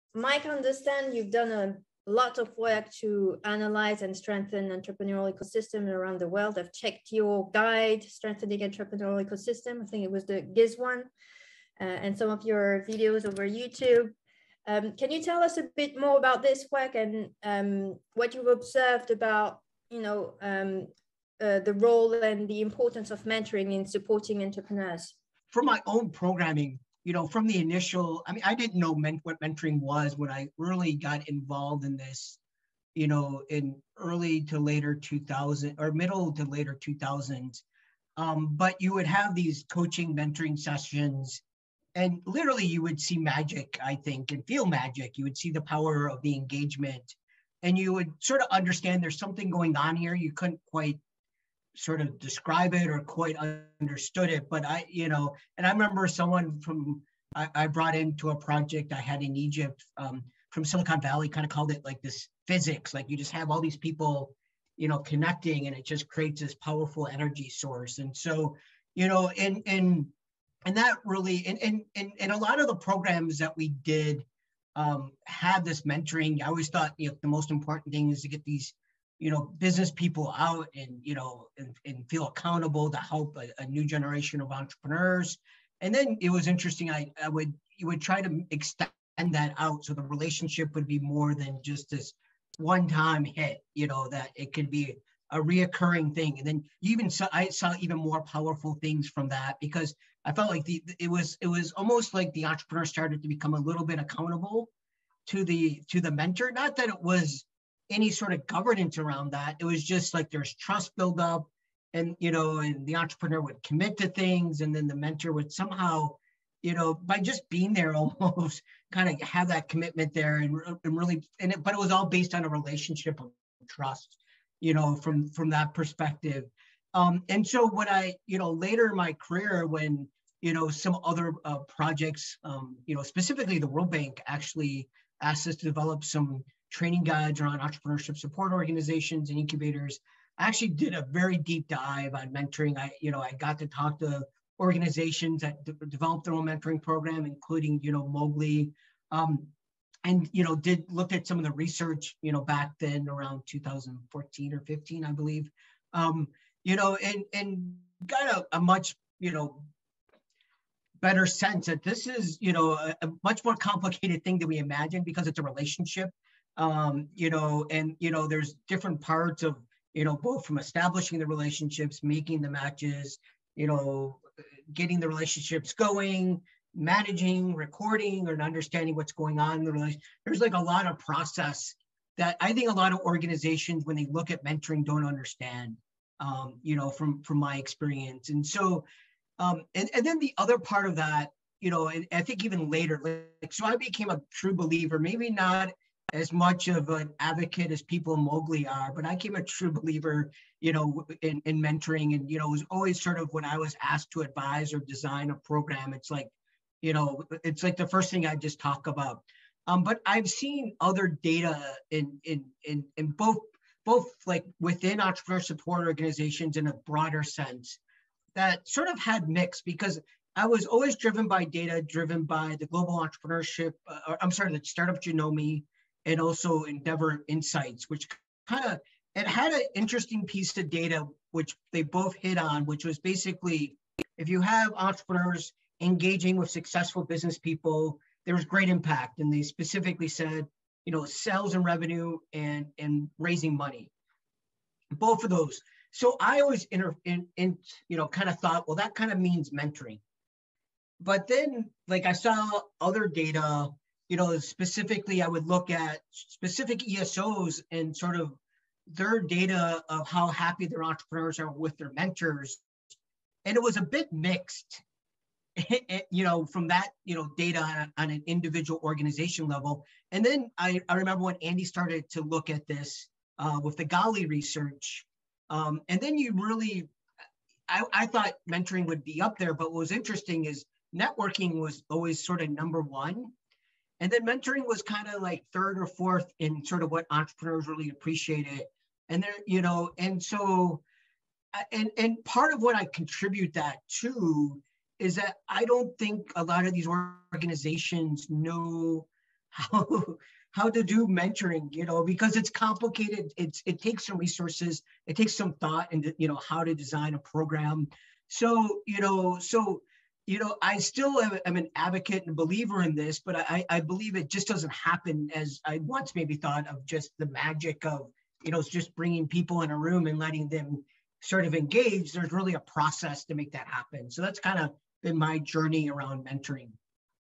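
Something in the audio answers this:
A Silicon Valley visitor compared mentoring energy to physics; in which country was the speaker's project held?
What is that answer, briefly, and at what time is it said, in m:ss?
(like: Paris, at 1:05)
Egypt, at 0:59.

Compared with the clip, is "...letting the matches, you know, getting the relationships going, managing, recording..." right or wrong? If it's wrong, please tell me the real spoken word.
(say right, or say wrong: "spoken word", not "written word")
wrong: "making", not "letting".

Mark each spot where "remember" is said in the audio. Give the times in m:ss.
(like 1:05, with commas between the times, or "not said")
0:55, 4:30.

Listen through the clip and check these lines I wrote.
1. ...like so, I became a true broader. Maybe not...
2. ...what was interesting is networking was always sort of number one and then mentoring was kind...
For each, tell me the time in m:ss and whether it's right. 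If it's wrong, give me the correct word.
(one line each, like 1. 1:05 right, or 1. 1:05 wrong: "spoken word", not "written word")
1. 3:13 wrong: "believer", not "broader"
2. 4:39 right.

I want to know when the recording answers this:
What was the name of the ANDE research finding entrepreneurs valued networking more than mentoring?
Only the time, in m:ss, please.
4:33.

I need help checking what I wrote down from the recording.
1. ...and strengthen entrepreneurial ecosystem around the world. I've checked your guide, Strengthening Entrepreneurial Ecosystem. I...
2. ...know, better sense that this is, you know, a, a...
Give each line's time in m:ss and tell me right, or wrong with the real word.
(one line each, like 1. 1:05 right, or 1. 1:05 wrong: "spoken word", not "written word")
1. 0:04 right
2. 2:39 right.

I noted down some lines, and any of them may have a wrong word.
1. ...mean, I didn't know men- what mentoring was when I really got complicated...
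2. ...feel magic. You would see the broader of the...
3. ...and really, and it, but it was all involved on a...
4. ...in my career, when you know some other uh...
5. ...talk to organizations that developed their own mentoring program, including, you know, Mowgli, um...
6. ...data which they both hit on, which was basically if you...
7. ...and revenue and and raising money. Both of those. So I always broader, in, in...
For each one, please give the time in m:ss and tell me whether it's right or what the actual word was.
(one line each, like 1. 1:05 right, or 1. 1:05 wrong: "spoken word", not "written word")
1. 0:28 wrong: "involved", not "complicated"
2. 0:44 wrong: "power", not "broader"
3. 2:00 wrong: "based", not "involved"
4. 2:08 right
5. 2:23 right
6. 3:50 right
7. 4:01 wrong: "inter", not "broader".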